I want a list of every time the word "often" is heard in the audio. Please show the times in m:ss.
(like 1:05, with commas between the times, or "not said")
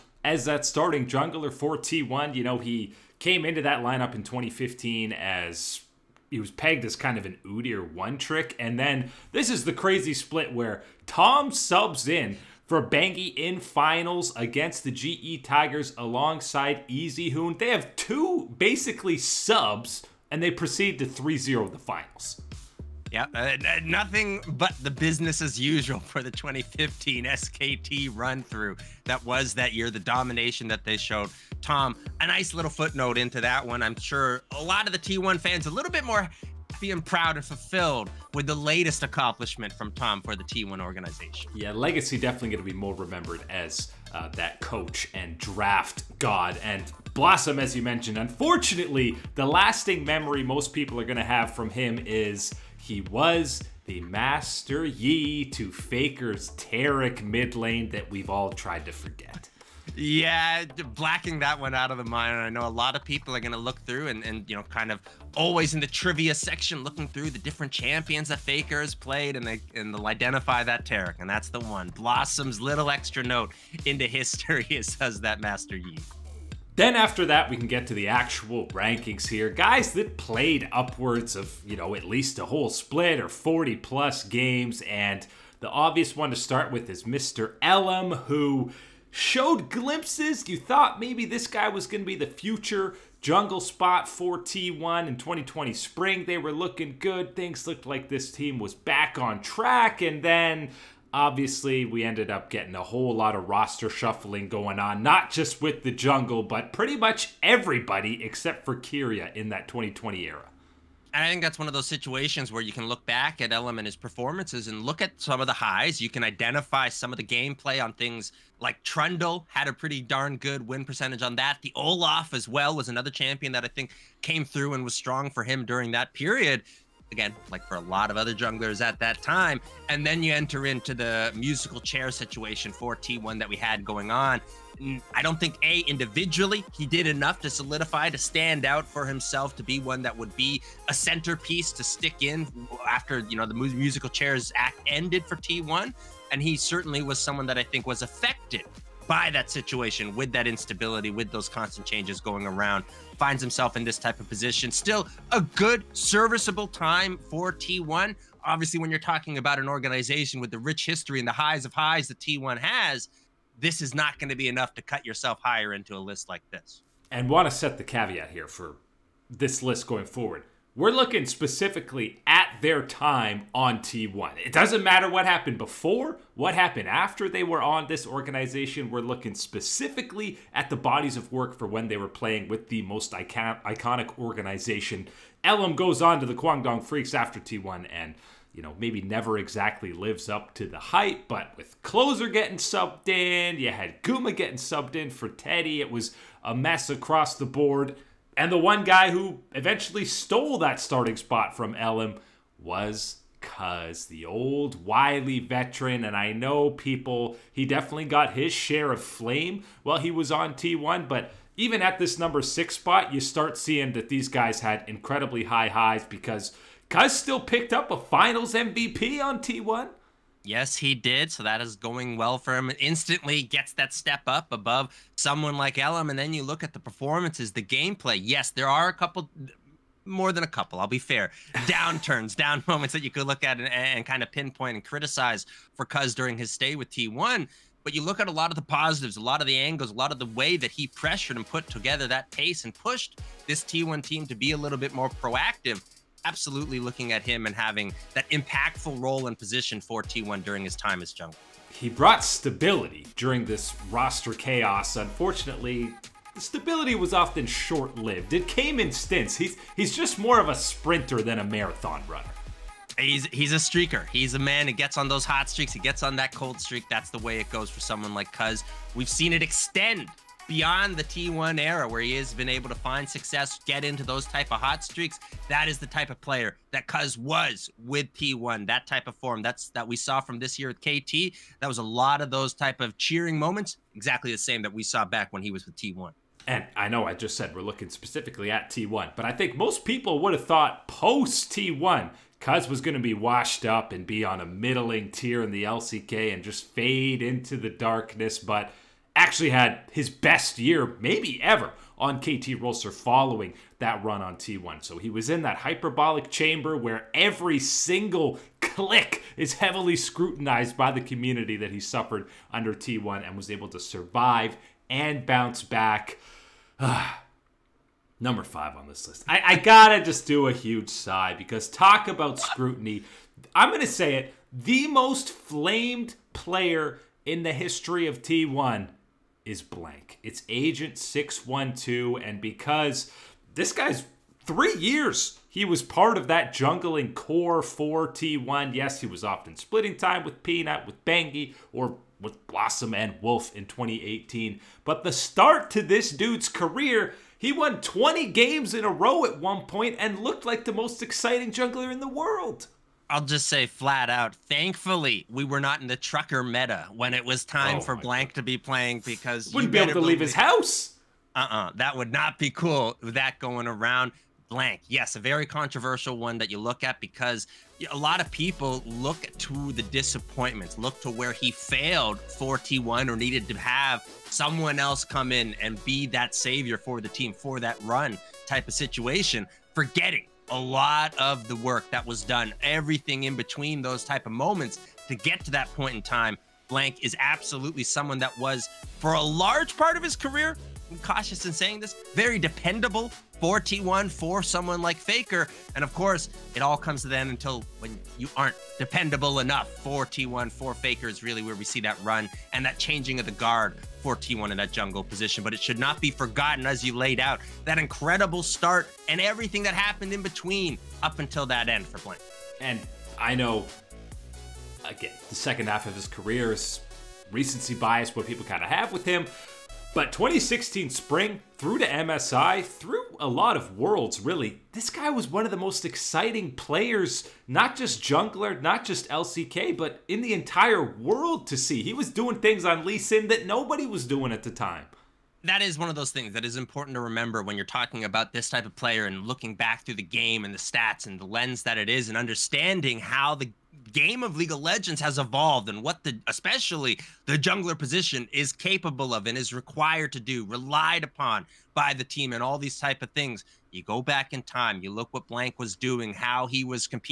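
4:17, 5:39.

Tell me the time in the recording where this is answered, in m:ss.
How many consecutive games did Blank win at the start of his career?
5:47.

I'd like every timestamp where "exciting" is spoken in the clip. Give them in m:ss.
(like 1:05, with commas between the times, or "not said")
5:51, 7:05.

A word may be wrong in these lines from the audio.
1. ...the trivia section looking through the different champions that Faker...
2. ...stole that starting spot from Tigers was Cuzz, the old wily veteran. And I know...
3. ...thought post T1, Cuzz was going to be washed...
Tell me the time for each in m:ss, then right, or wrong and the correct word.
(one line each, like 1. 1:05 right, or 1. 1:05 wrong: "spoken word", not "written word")
1. 1:05 right
2. 3:20 wrong: "Ellim", not "Tigers"
3. 4:50 right.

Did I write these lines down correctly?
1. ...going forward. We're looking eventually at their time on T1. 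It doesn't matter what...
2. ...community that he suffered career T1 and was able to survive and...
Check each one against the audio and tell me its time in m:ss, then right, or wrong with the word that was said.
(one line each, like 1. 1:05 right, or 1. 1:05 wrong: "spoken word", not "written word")
1. 2:49 wrong: "specifically", not "eventually"
2. 5:11 wrong: "under", not "career".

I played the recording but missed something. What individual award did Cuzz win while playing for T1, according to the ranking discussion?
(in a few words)
finals MVP.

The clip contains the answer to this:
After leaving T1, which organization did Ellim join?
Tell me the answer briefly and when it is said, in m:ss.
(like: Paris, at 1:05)
Kwangdong Freecs, at 3:06.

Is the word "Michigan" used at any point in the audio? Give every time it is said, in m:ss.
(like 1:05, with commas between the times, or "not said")
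not said.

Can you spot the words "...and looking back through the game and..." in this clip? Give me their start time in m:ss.
7:19.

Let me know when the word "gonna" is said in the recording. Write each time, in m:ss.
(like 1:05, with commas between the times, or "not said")
5:23.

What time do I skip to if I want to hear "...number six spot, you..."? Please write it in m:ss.
3:32.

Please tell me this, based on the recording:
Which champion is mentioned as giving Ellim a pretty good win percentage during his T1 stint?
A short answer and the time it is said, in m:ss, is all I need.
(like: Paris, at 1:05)
Trundle, at 1:58.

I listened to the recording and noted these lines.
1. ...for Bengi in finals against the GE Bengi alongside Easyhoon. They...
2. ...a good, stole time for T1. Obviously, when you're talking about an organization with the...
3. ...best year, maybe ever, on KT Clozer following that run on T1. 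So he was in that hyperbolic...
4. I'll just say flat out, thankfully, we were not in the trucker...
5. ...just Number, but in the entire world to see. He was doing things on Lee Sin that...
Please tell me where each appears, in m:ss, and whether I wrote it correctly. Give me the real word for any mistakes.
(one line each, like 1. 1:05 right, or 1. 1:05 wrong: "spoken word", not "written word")
1. 0:12 wrong: "Tigers", not "Bengi"
2. 2:35 wrong: "serviceable", not "stole"
3. 5:00 wrong: "Rolster", not "Clozer"
4. 5:53 right
5. 7:08 wrong: "LCK", not "Number".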